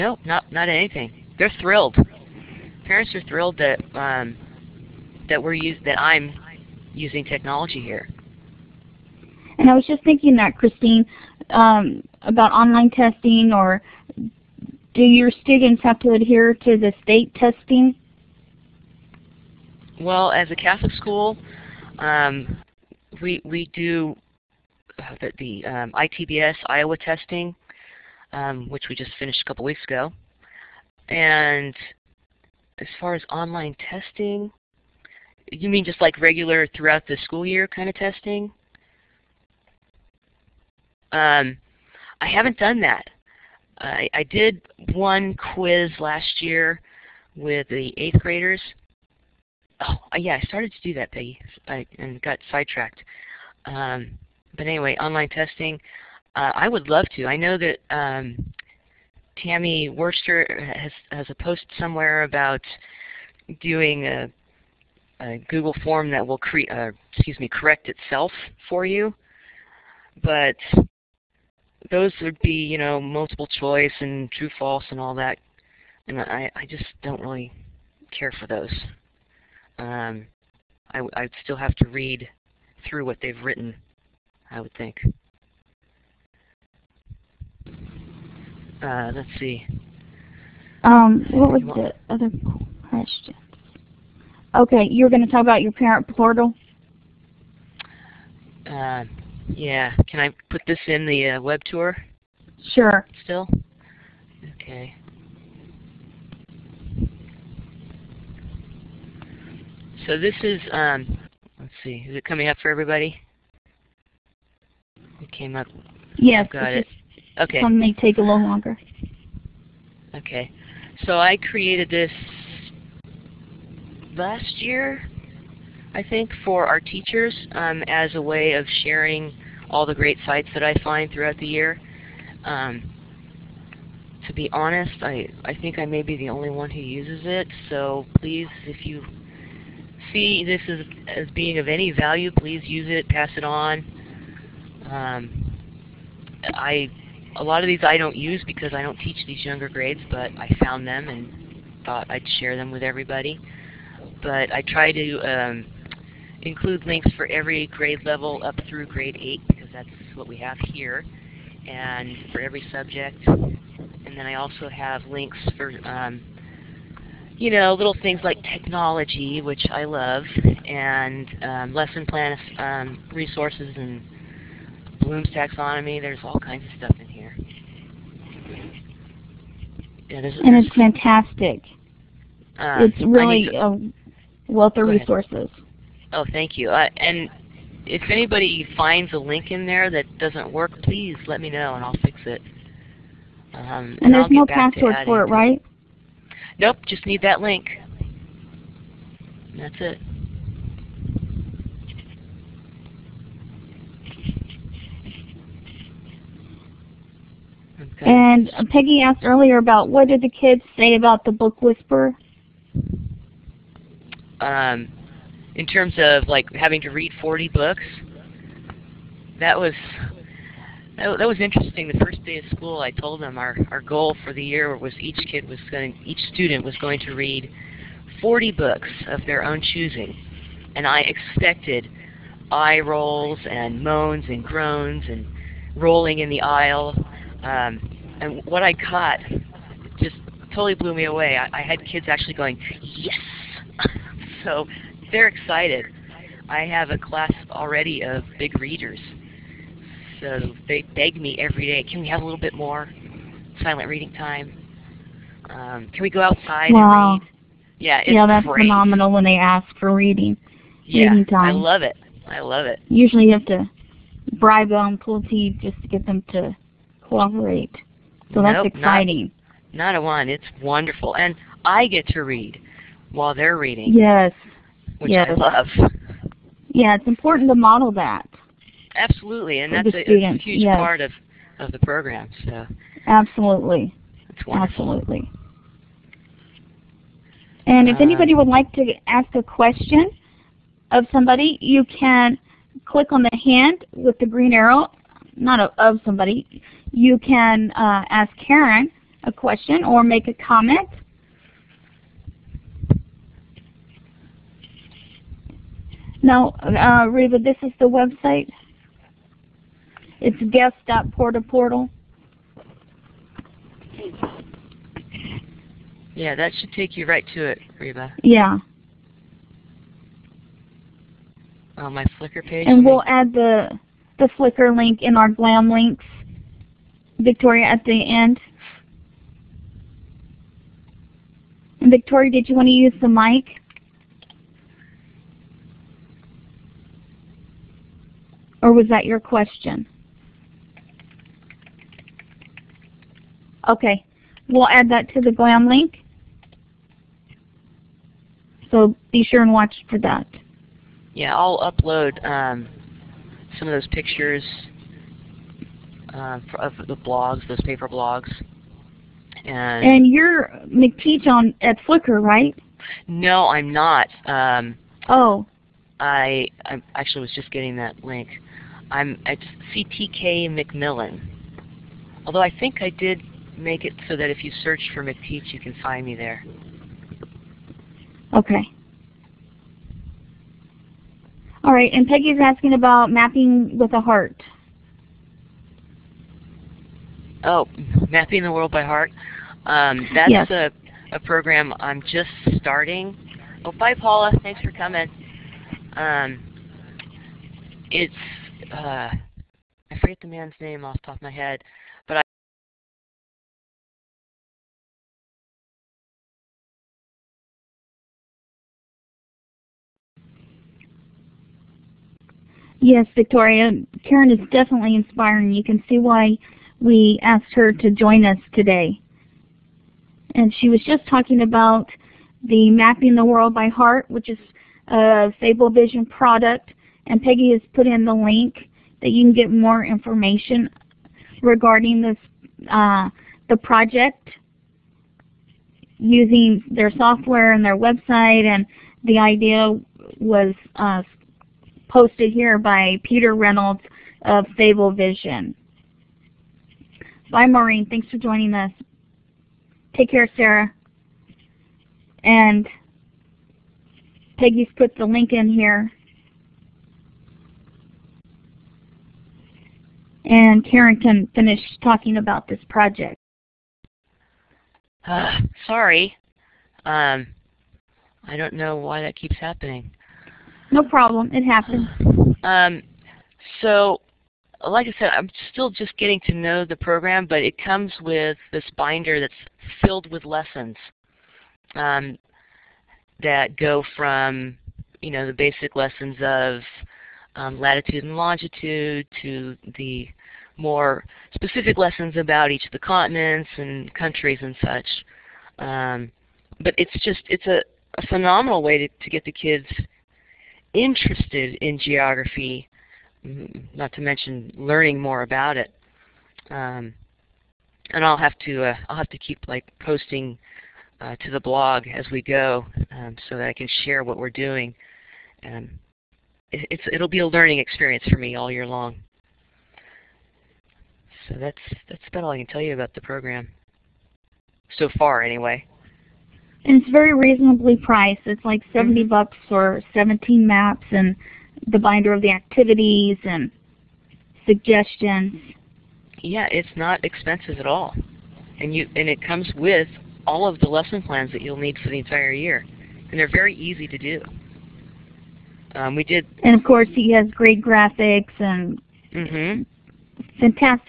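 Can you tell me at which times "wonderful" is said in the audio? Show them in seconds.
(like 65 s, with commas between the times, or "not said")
270 s, 284 s.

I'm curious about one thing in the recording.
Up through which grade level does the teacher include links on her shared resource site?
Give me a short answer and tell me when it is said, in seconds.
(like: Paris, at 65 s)
grade 8, at 158 s.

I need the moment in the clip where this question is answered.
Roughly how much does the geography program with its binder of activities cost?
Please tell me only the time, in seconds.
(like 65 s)
528 s.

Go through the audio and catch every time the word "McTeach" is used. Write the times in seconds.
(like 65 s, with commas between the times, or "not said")
360 s, 375 s.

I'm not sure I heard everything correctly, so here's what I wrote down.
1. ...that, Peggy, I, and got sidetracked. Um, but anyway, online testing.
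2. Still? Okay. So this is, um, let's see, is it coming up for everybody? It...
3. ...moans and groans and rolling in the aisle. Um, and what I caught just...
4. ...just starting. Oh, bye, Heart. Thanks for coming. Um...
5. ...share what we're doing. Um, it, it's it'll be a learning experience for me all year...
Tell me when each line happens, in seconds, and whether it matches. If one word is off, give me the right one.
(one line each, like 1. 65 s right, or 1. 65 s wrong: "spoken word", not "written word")
1. 50 s right
2. 103 s right
3. 233 s right
4. 392 s wrong: "Paula", not "Heart"
5. 513 s right.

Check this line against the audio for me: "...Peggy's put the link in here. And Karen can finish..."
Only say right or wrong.
right.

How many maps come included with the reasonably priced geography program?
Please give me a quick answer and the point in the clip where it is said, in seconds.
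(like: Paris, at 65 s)
17, at 529 s.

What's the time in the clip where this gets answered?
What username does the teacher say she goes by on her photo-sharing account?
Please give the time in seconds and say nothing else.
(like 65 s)
369 s.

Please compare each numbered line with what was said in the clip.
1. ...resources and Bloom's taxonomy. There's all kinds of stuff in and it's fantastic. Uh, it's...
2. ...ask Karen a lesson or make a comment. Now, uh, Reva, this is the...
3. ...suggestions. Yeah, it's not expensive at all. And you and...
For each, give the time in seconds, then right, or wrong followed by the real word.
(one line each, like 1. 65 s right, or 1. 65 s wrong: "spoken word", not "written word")
1. 173 s right
2. 298 s wrong: "question", not "lesson"
3. 534 s right.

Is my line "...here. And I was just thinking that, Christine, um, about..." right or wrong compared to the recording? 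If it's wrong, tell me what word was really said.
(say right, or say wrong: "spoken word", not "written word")
right.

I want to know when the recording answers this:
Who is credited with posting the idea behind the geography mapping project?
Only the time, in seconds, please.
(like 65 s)
443 s.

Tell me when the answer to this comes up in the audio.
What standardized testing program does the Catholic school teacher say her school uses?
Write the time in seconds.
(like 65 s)
25 s.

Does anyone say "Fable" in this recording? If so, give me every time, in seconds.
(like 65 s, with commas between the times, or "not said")
425 s, 444 s.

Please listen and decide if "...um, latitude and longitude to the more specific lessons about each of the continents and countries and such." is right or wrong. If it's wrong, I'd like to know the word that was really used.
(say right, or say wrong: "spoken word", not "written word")
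right.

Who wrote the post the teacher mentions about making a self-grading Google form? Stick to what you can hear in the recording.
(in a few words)
Tammy Worcester.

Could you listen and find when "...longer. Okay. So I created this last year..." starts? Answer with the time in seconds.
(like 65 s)
118 s.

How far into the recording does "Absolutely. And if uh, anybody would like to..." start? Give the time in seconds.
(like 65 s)
284 s.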